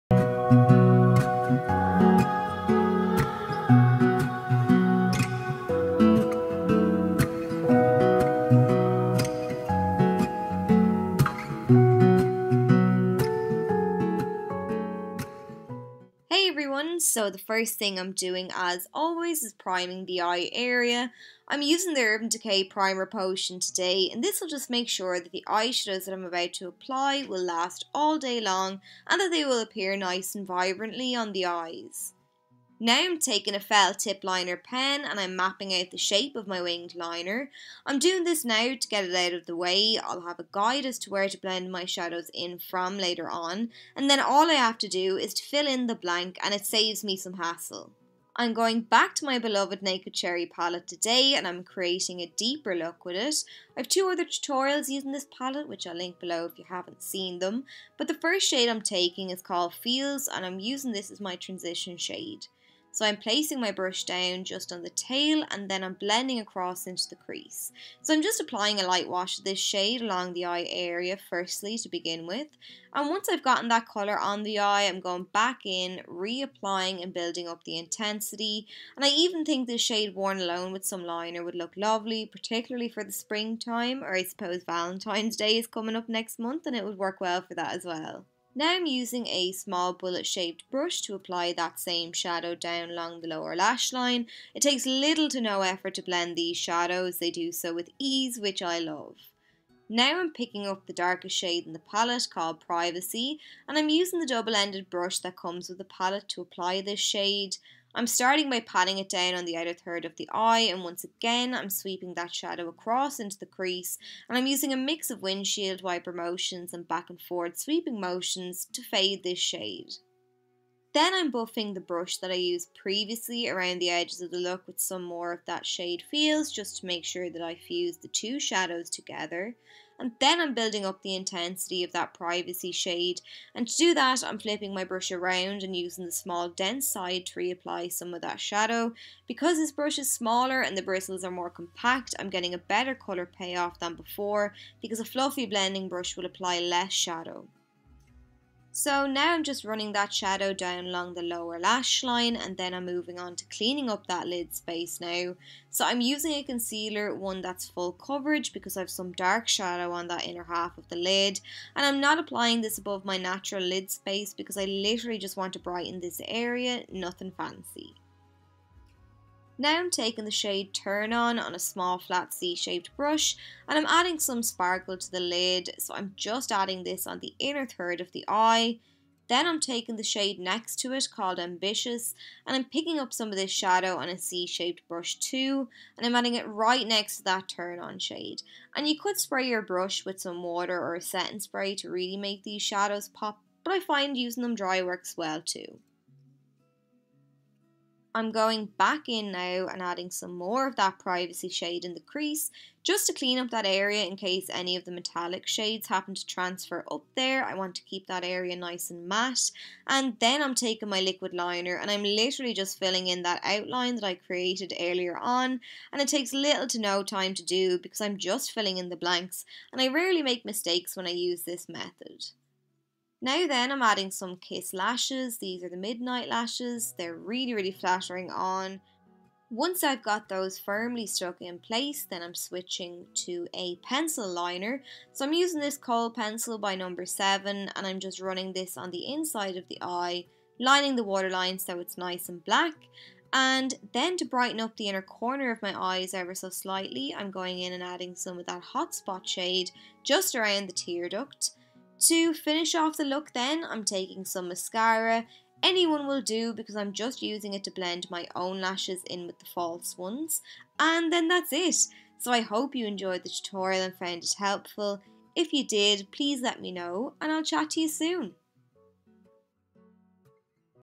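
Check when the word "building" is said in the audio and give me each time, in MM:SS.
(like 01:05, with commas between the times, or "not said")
01:17, 02:10.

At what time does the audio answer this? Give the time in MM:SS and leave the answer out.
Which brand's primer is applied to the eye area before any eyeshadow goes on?
00:22.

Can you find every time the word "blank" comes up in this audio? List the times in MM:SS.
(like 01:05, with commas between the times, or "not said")
00:45, 03:38.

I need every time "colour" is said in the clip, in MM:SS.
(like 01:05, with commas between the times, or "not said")
01:13, 02:22.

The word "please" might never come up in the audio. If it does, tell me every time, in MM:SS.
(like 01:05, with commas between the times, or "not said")
04:26.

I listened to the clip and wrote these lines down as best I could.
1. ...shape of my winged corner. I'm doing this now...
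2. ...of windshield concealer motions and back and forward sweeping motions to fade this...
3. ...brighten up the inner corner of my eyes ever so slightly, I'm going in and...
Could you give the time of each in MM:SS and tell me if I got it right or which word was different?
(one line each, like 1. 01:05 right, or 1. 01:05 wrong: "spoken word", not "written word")
1. 00:35 wrong: "liner", not "corner"
2. 01:55 wrong: "wiper", not "concealer"
3. 04:04 right.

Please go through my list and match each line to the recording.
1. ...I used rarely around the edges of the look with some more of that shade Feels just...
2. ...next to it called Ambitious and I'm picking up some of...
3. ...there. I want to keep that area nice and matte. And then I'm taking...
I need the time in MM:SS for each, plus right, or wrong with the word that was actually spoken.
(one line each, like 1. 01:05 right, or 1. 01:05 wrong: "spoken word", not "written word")
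1. 02:02 wrong: "previously", not "rarely"
2. 03:00 right
3. 03:27 right.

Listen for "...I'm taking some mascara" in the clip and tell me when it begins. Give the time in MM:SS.
04:13.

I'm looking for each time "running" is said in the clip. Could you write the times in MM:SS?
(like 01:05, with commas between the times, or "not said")
02:29, 03:58.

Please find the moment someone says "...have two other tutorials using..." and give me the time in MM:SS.
00:53.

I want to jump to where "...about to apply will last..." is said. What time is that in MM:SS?
00:26.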